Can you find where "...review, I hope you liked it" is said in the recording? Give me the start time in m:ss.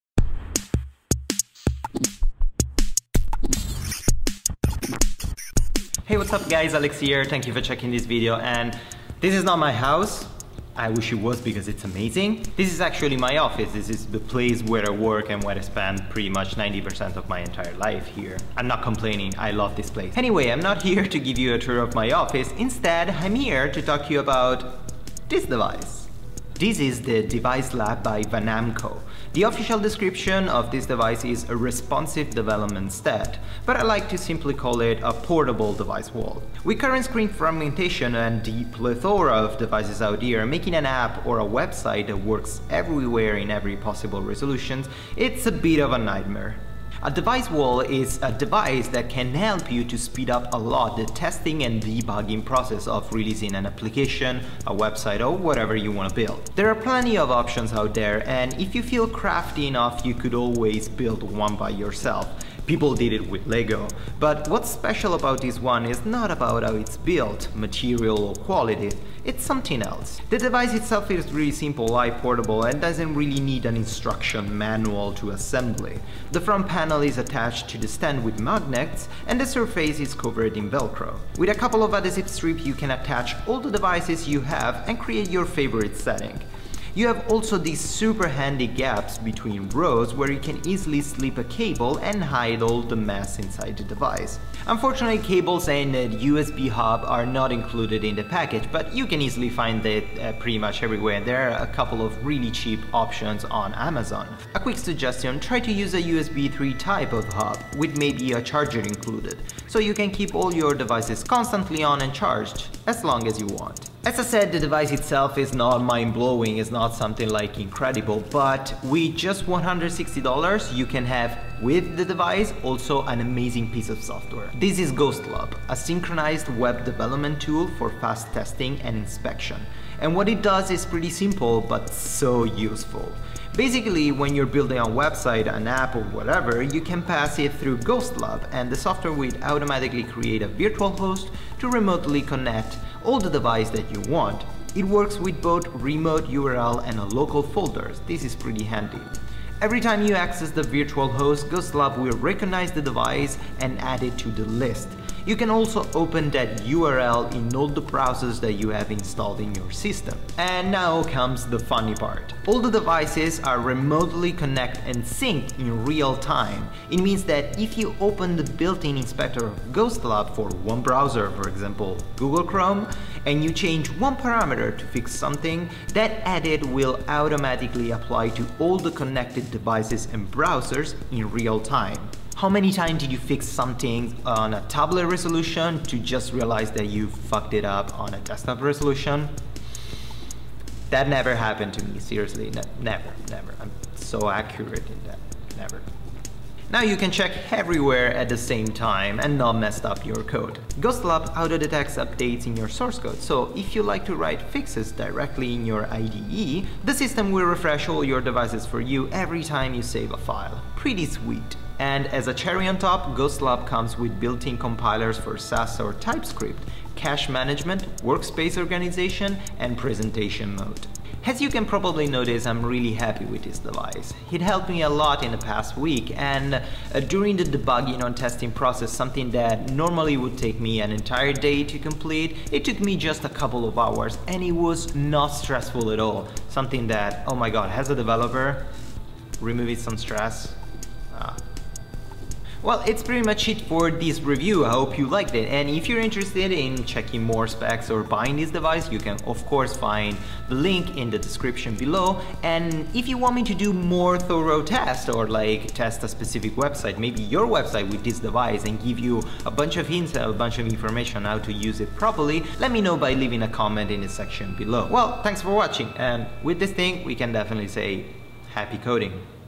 4:04.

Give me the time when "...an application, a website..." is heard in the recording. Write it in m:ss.
0:53.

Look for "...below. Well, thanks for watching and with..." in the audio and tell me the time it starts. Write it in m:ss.
4:24.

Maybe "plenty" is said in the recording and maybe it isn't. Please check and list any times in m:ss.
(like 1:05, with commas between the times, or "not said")
0:56.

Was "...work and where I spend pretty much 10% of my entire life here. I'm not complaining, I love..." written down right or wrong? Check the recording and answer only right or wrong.
wrong.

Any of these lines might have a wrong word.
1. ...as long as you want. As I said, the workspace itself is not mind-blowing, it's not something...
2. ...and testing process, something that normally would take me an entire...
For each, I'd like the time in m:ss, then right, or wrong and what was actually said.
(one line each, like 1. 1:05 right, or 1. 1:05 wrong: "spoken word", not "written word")
1. 1:52 wrong: "device", not "workspace"
2. 3:48 right.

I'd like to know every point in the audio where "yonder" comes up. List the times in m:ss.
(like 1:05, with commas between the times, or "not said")
not said.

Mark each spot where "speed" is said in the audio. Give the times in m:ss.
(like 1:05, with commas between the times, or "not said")
0:49.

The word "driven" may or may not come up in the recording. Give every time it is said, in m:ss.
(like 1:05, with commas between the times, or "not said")
not said.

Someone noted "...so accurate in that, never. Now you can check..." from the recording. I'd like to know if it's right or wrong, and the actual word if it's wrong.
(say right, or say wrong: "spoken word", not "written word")
right.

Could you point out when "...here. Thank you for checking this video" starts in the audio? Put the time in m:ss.
0:06.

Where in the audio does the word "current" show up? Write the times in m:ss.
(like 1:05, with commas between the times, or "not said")
0:36.